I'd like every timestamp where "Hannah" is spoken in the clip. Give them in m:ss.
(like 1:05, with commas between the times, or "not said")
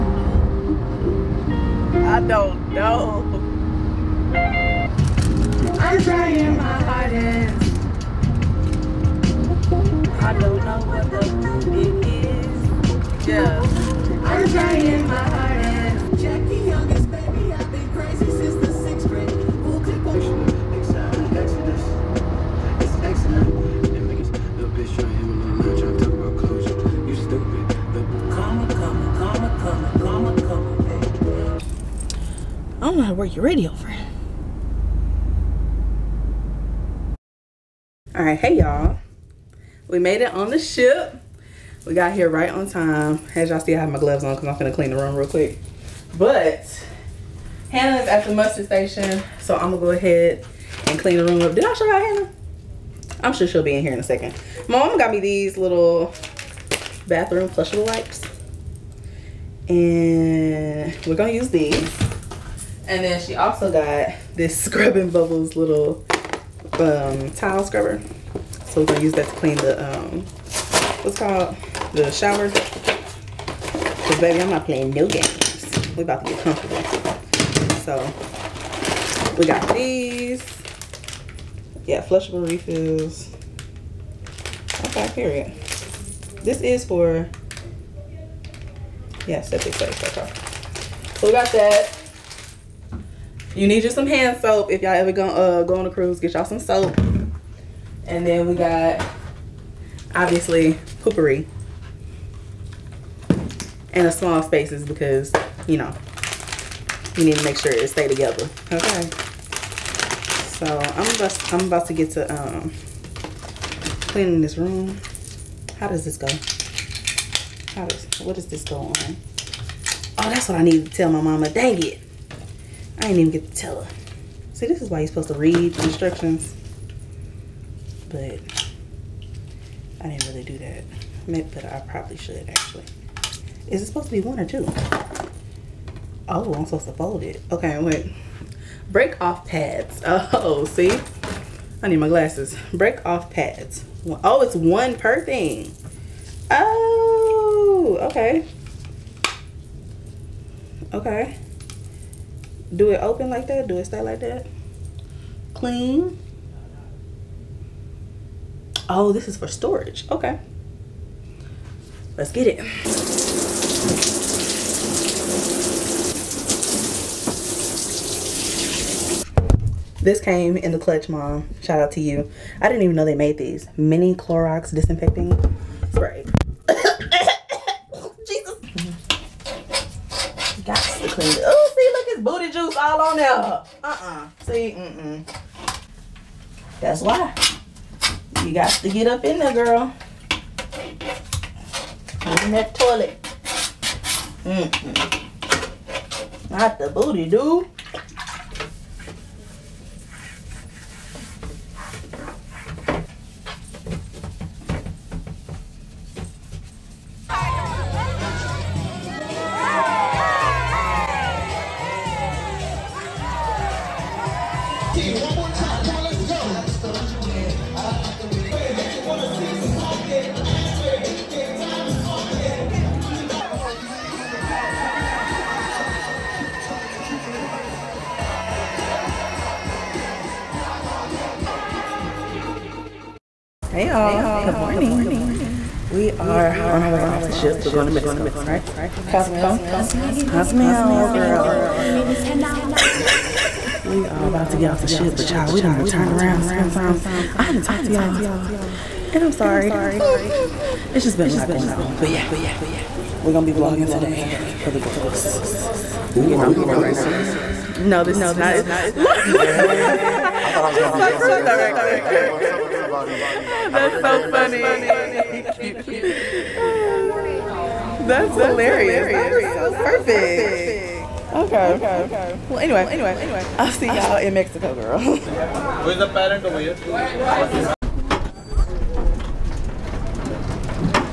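0:47, 0:52.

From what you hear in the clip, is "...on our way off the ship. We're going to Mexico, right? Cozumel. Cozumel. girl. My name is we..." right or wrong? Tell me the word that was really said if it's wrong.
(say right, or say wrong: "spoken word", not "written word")
right.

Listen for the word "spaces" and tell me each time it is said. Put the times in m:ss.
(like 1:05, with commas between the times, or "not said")
1:44.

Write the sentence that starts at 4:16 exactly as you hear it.
we are we gonna be right like, now.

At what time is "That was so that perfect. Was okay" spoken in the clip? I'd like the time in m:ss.
4:29.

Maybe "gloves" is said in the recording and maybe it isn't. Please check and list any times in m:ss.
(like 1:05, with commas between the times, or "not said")
0:43.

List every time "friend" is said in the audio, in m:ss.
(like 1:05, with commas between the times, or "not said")
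0:33.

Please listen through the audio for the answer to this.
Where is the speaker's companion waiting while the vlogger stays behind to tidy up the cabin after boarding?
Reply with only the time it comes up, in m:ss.
0:48.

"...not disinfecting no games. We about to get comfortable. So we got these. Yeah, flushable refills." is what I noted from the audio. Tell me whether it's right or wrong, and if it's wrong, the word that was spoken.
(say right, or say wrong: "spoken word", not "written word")
wrong: "playing", not "disinfecting".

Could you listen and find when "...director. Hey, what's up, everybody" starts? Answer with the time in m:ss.
4:21.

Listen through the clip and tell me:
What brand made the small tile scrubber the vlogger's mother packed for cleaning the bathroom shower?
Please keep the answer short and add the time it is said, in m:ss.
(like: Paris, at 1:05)
Scrubbing Bubbles, at 1:04.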